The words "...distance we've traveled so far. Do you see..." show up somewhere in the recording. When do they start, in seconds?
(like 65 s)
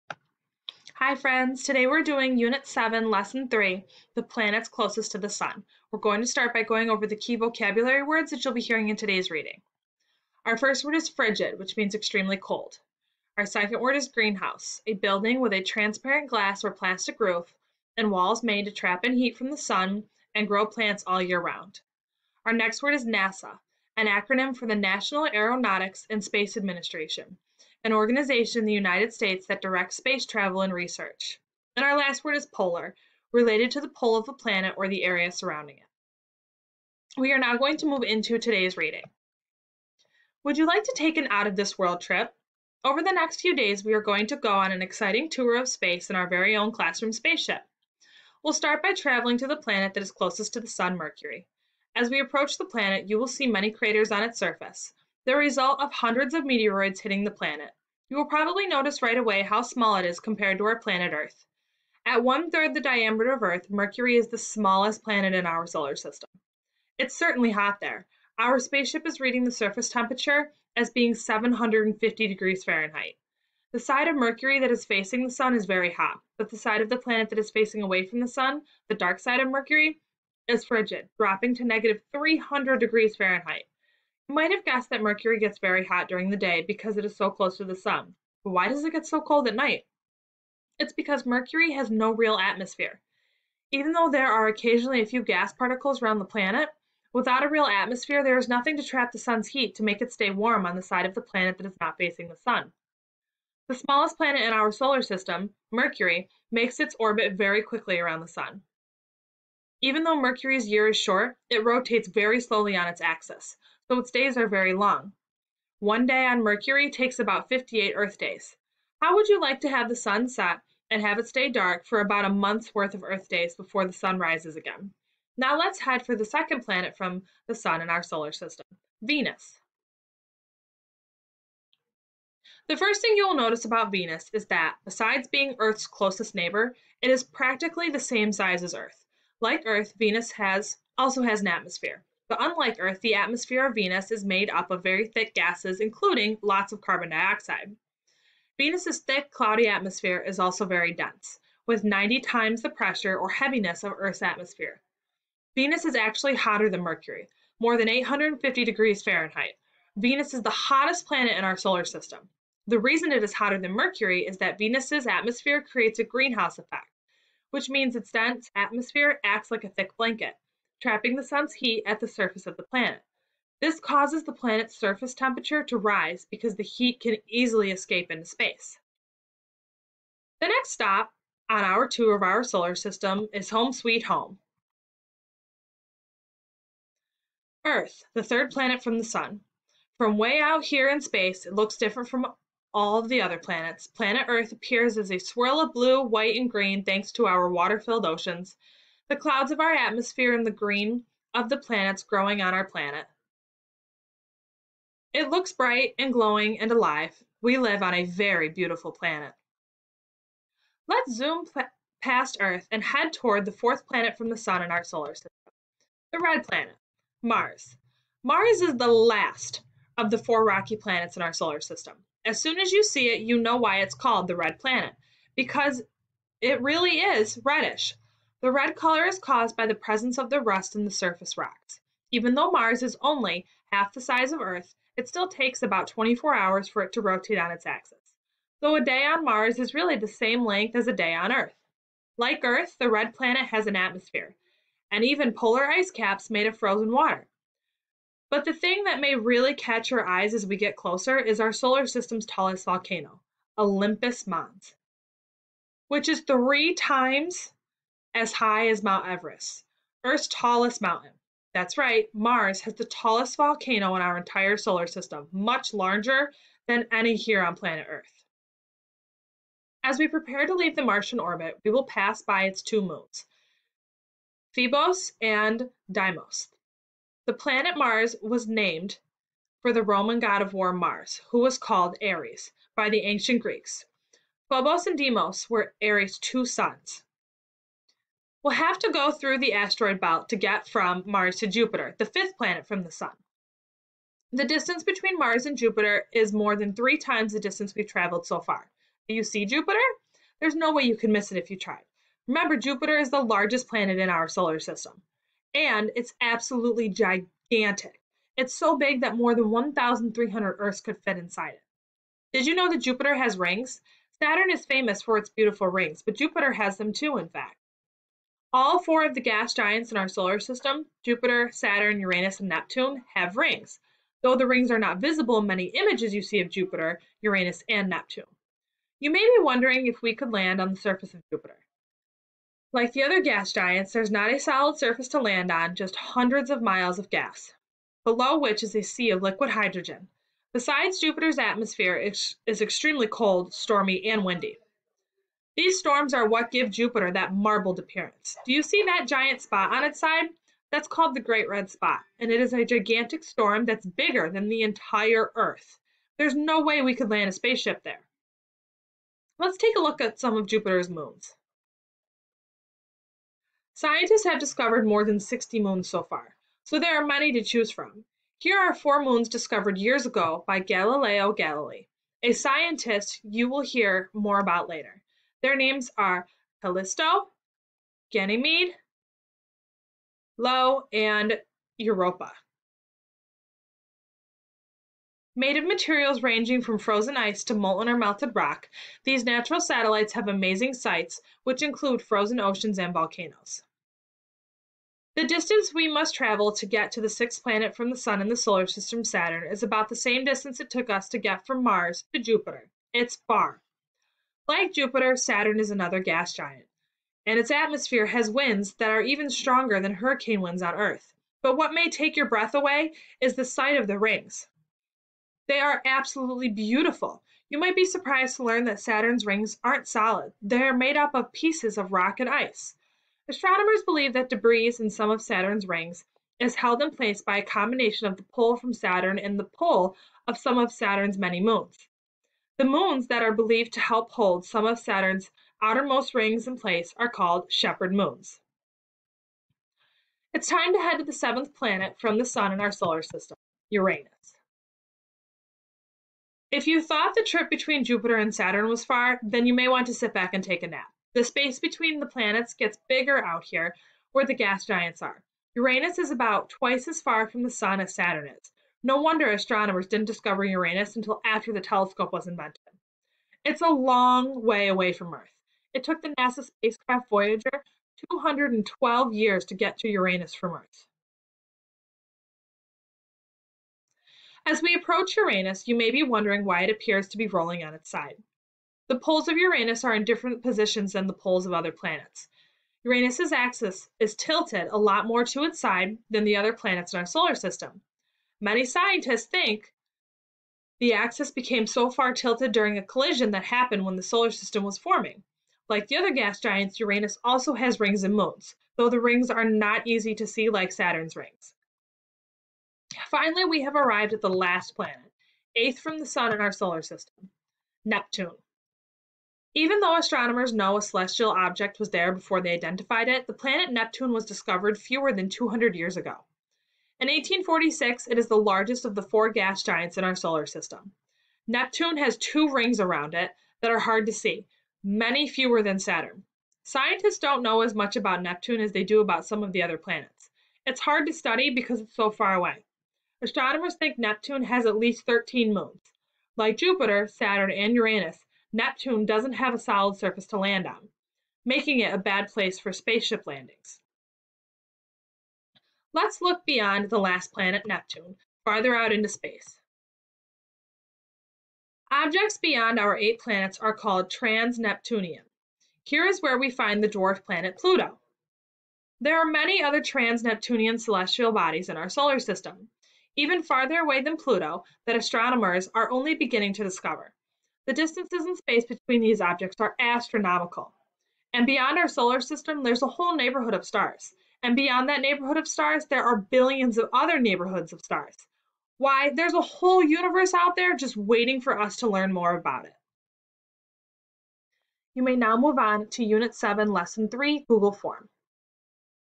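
297 s.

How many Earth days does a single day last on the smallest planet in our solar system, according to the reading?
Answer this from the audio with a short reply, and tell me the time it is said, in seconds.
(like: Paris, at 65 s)
58, at 117 s.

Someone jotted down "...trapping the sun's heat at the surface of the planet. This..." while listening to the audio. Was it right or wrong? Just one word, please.
right.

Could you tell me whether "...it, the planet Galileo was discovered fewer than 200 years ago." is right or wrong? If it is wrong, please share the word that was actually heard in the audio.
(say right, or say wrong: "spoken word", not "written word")
wrong: "Neptune", not "Galileo".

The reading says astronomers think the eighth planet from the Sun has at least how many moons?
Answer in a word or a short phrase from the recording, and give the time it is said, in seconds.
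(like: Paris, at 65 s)
13, at 534 s.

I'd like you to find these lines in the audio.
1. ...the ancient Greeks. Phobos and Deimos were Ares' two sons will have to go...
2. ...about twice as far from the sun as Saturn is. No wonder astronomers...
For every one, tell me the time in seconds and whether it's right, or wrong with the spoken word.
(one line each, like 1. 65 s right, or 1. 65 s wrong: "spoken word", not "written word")
1. 282 s right
2. 456 s right.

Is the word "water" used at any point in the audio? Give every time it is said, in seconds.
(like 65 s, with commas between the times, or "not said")
197 s, 246 s.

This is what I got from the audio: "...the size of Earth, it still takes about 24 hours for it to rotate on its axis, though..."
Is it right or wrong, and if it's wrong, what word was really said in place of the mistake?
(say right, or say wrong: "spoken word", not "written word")
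right.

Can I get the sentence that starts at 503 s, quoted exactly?
Finally, we have arrived at the last planet, eighth from the Sun in our solar system, Neptune.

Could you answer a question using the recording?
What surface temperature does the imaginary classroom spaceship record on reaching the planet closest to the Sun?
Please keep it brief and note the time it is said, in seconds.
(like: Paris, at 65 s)
750 degrees Fahrenheit, at 71 s.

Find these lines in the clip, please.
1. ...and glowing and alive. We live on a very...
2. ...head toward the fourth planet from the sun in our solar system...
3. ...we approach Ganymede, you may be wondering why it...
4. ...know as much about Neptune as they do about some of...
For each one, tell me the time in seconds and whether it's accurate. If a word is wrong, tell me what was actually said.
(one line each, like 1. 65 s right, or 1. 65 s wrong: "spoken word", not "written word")
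1. 205 s right
2. 212 s right
3. 474 s wrong: "Uranus", not "Ganymede"
4. 527 s right.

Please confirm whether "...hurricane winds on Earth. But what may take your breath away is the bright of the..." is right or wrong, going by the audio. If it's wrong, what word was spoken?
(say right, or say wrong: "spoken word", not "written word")
wrong: "sight", not "bright".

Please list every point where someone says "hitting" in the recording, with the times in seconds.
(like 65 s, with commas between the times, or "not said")
57 s.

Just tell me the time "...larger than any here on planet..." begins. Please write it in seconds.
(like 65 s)
265 s.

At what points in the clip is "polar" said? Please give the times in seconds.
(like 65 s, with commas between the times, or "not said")
32 s, 245 s.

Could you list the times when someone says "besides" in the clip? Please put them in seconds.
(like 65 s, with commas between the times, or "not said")
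134 s, 340 s.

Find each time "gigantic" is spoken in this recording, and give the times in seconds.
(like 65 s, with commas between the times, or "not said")
306 s, 352 s.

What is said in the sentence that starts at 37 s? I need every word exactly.
We are now going to move into today's reading.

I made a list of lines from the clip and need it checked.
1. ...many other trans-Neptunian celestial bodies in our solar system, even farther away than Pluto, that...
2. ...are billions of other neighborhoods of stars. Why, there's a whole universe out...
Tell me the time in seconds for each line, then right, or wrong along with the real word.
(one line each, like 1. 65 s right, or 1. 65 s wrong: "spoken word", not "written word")
1. 559 s right
2. 576 s right.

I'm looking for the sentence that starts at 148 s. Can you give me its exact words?
Venus's thick, cloudy atmosphere is also very dense, with 90 times the pressure or heaviness of Earth's atmosphere.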